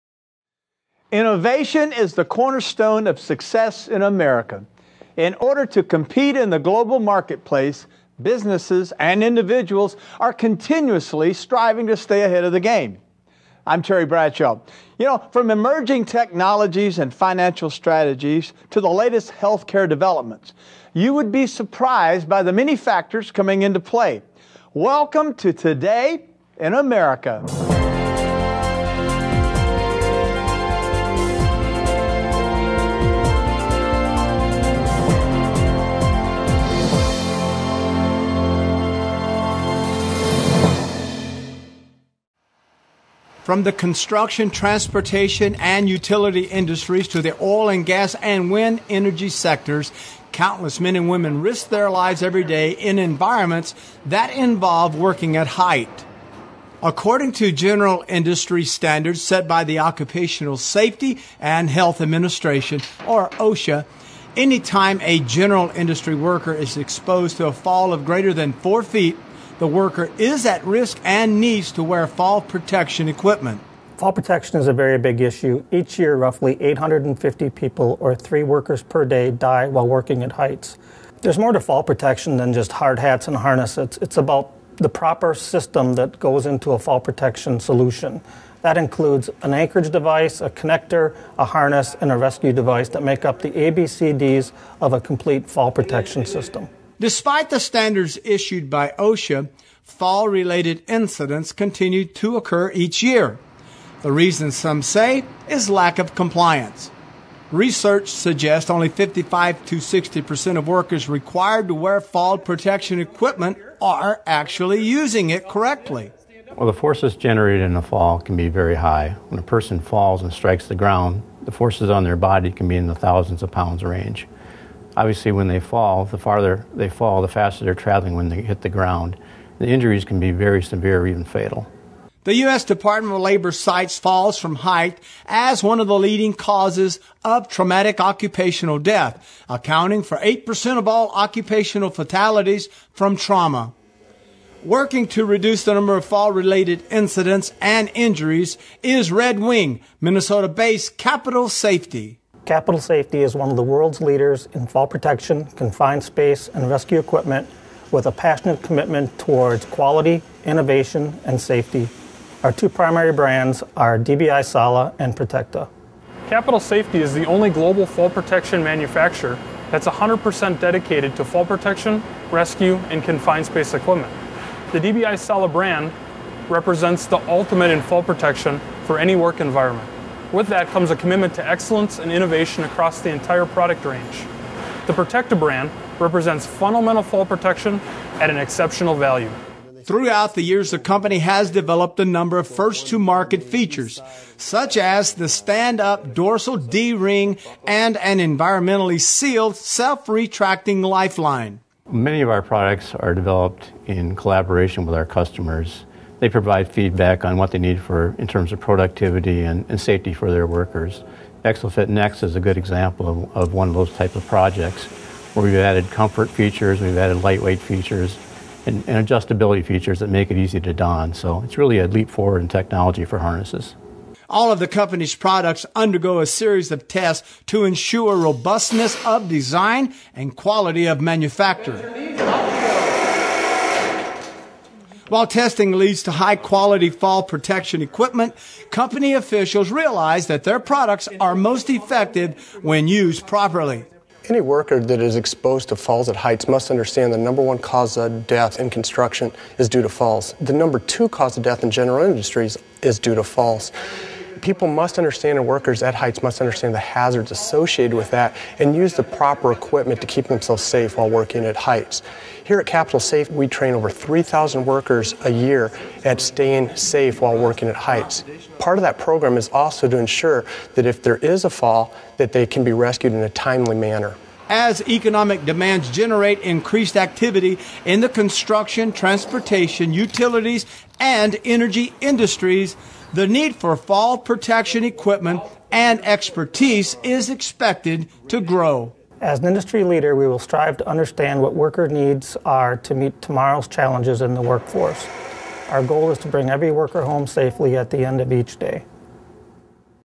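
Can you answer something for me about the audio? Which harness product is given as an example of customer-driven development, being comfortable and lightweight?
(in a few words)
ExoFit Next.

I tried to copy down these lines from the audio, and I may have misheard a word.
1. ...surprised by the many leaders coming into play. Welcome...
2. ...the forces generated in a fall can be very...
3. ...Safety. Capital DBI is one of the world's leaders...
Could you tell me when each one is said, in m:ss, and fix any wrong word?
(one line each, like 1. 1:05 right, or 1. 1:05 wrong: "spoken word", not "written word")
1. 0:21 wrong: "factors", not "leaders"
2. 1:56 right
3. 2:31 wrong: "Safety", not "DBI".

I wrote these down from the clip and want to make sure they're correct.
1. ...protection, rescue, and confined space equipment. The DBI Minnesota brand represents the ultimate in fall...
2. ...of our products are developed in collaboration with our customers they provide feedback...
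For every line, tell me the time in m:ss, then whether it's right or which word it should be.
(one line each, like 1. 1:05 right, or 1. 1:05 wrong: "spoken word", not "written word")
1. 2:51 wrong: "Sala", not "Minnesota"
2. 3:22 right.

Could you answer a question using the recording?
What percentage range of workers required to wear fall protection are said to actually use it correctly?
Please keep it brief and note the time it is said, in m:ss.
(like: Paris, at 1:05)
55 to 60 percent, at 1:48.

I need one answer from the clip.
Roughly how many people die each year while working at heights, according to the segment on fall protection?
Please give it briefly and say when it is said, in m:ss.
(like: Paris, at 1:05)
850, at 1:16.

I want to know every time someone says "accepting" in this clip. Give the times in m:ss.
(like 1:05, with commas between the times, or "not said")
not said.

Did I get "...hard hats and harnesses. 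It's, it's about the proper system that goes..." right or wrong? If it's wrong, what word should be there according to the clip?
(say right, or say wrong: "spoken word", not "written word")
right.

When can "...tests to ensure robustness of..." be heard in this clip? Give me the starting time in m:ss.
3:46.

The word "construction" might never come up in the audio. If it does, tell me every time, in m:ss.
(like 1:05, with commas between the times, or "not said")
0:43, 4:08, 4:38.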